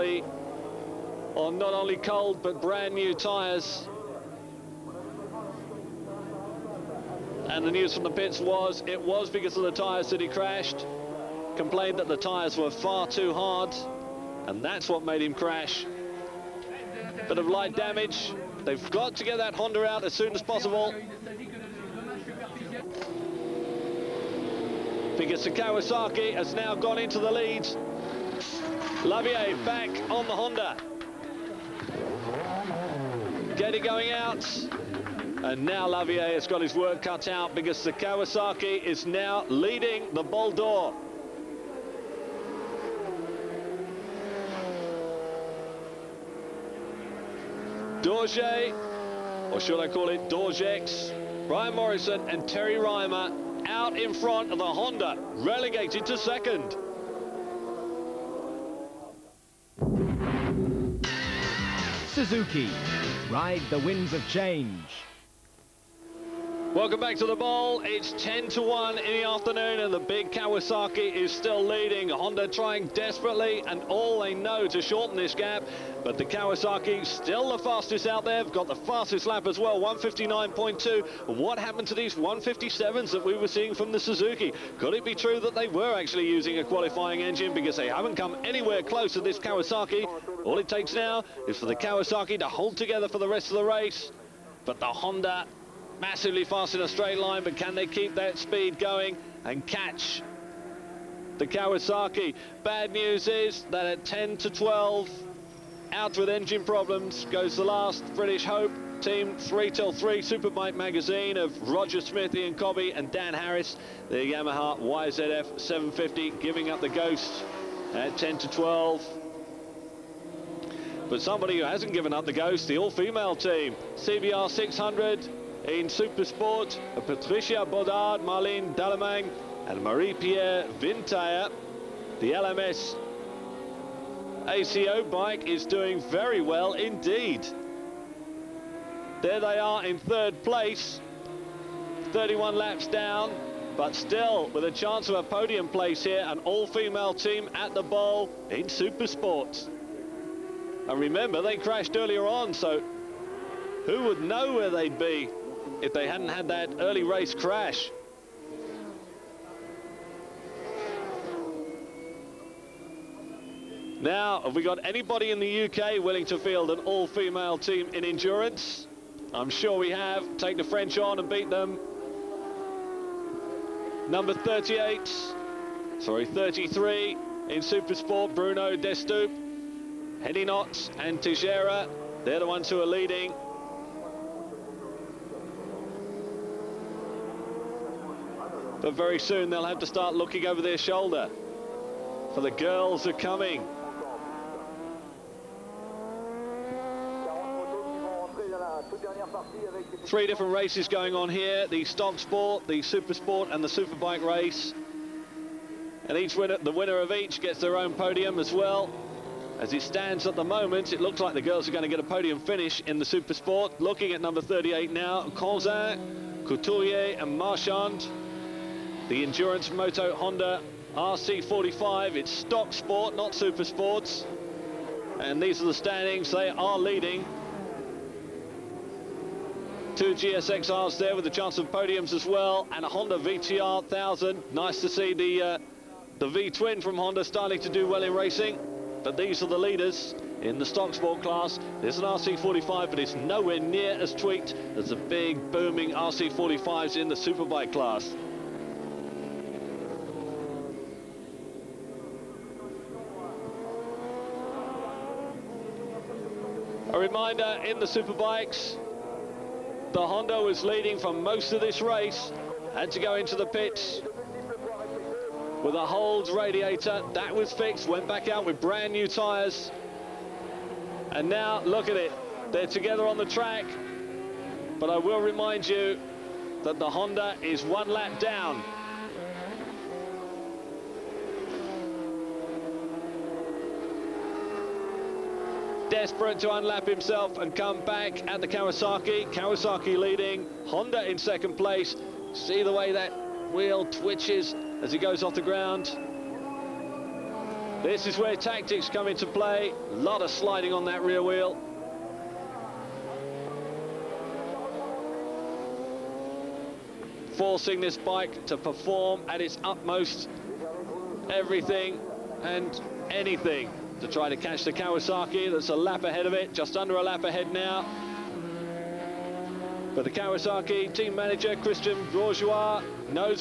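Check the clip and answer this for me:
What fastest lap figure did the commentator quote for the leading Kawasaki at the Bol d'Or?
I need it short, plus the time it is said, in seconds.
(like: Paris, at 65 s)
159.2, at 79 s.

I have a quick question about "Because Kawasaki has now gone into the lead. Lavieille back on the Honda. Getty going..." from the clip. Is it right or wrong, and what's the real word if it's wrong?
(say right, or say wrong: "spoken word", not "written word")
right.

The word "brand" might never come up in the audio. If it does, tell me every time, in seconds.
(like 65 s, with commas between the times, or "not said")
2 s, 268 s.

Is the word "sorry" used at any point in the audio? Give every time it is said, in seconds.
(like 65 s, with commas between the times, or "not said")
175 s.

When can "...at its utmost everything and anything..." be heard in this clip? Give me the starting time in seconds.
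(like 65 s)
309 s.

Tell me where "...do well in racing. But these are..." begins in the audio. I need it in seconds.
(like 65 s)
237 s.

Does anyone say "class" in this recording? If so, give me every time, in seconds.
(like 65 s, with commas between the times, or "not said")
241 s, 247 s.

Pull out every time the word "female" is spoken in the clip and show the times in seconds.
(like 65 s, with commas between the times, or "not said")
122 s, 146 s, 166 s.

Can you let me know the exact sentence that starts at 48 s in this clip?
Dorje, or should I call it D'Orgeix, Brian Morrison and Terry Rymer out in front of the Honda, relegated to second.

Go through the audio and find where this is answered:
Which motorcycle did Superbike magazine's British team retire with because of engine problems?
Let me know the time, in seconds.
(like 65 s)
114 s.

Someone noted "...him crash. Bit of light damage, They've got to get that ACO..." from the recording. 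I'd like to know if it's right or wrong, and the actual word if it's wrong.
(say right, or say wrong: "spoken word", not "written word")
wrong: "Honda", not "ACO".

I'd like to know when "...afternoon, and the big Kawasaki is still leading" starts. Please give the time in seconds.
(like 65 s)
69 s.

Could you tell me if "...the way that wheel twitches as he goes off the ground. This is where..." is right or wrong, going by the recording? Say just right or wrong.
right.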